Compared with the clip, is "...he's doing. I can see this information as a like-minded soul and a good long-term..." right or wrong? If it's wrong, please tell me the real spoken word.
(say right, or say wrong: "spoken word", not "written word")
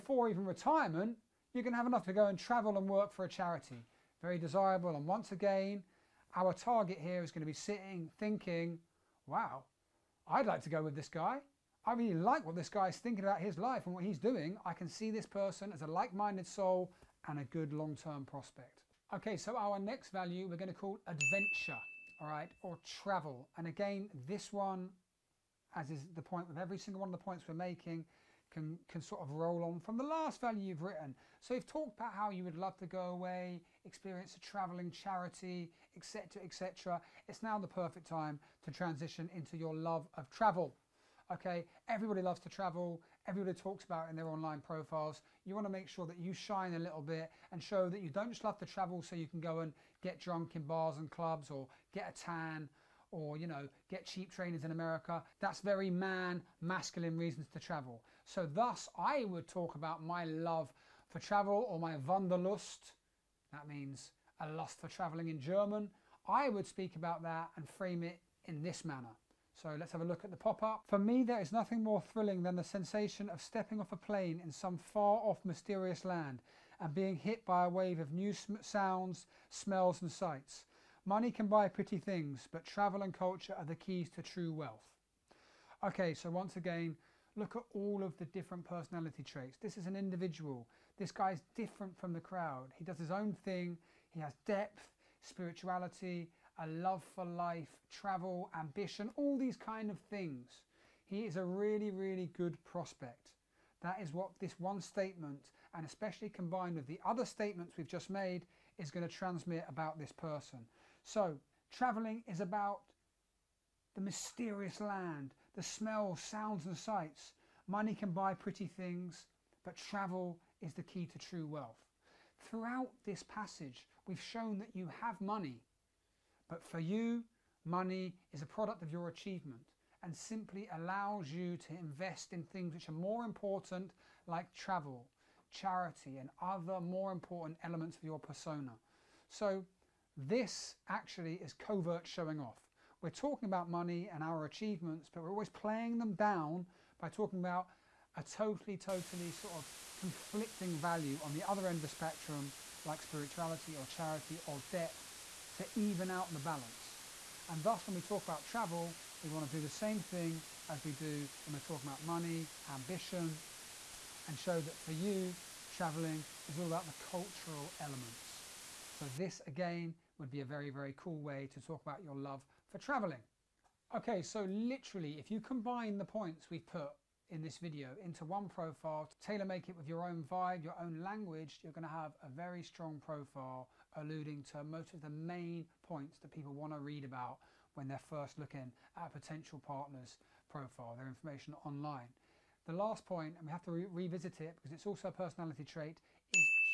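wrong: "person", not "information".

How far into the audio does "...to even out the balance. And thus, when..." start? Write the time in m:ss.
2:35.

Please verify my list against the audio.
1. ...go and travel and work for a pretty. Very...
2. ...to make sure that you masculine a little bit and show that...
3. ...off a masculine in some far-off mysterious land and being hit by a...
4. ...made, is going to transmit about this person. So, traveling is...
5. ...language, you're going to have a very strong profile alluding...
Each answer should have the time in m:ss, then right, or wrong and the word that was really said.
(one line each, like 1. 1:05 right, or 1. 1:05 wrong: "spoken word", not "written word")
1. 0:02 wrong: "charity", not "pretty"
2. 0:45 wrong: "shine", not "masculine"
3. 1:13 wrong: "plane", not "masculine"
4. 1:48 right
5. 3:01 right.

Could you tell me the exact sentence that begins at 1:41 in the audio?
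He is a really, really good prospect.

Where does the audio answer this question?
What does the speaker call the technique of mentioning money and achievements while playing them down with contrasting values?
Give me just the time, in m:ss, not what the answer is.
2:21.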